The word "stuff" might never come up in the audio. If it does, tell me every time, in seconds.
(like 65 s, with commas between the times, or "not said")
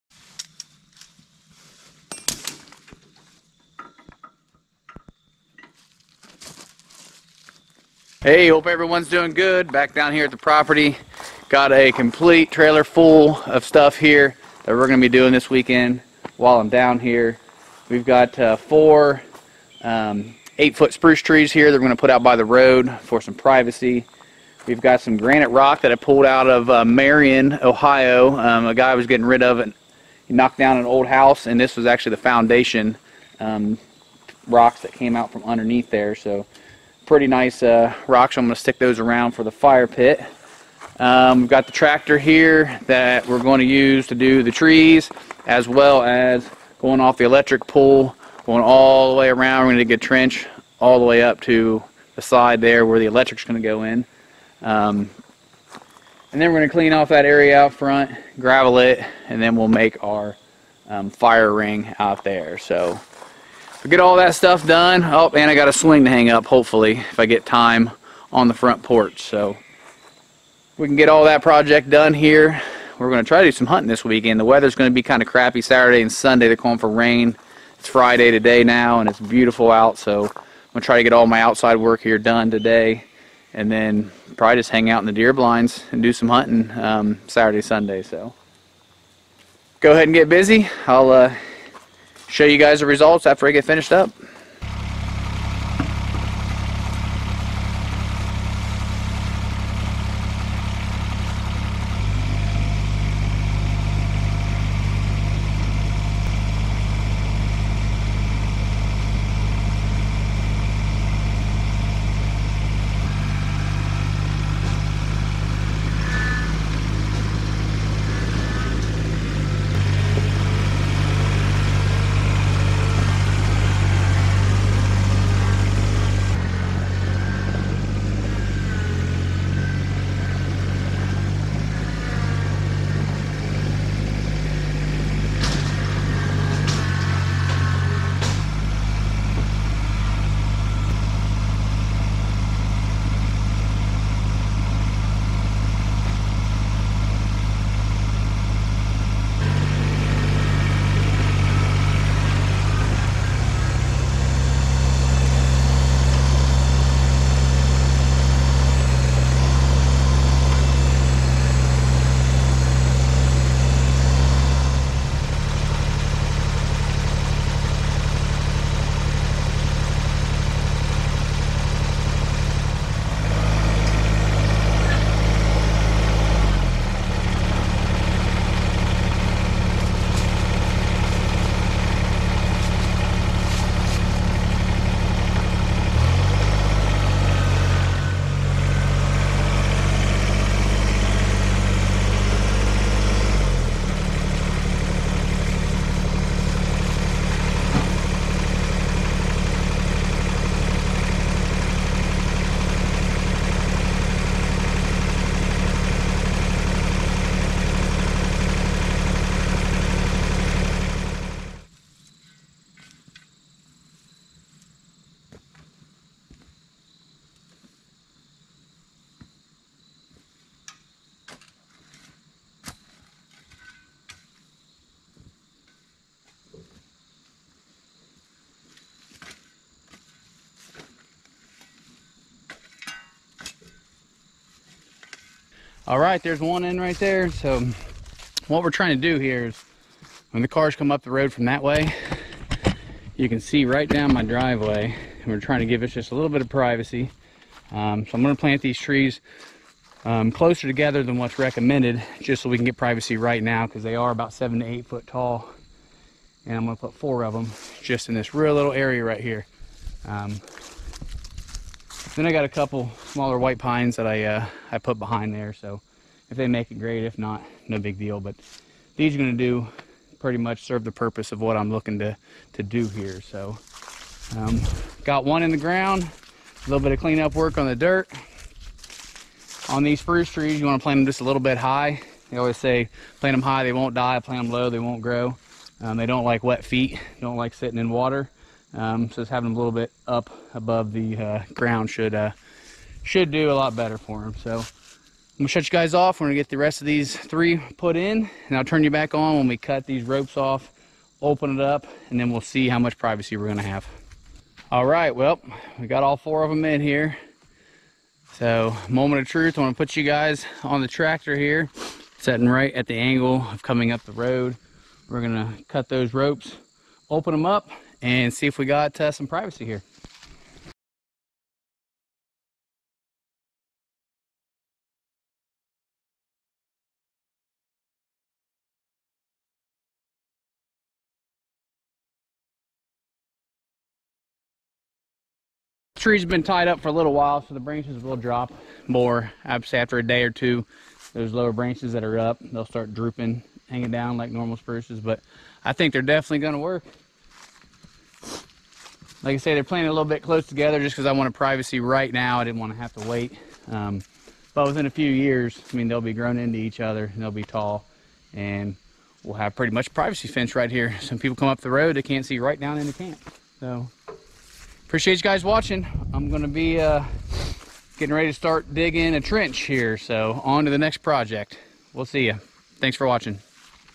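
13 s, 64 s.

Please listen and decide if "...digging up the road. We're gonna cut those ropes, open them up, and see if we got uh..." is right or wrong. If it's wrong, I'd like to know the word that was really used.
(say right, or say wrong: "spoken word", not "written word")
wrong: "coming", not "digging".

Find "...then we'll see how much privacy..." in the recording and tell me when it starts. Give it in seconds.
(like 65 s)
302 s.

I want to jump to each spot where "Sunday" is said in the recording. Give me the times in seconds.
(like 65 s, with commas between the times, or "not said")
76 s, 87 s.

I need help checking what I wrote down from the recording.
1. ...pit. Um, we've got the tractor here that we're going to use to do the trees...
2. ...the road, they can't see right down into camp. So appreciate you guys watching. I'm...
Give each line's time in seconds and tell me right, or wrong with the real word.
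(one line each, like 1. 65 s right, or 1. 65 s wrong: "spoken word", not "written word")
1. 39 s right
2. 361 s right.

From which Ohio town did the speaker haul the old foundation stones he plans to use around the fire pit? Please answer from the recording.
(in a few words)
Marion, Ohio.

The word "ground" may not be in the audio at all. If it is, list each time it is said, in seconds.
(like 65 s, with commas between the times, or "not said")
275 s, 291 s.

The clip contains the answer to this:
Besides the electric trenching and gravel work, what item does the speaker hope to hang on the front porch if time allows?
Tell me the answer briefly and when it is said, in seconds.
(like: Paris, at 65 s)
A swing, at 65 s.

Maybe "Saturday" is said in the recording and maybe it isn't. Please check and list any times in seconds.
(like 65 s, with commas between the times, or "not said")
75 s, 87 s.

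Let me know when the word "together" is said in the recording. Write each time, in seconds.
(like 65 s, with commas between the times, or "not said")
250 s, 350 s.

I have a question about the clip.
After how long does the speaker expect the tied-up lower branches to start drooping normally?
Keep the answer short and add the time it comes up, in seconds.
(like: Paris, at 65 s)
A day or two, at 339 s.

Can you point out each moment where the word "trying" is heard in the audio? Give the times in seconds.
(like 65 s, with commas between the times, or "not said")
238 s, 245 s.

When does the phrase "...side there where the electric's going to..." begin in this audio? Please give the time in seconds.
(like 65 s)
52 s.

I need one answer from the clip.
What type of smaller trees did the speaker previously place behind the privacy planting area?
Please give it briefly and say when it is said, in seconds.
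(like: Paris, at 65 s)
White pines, at 263 s.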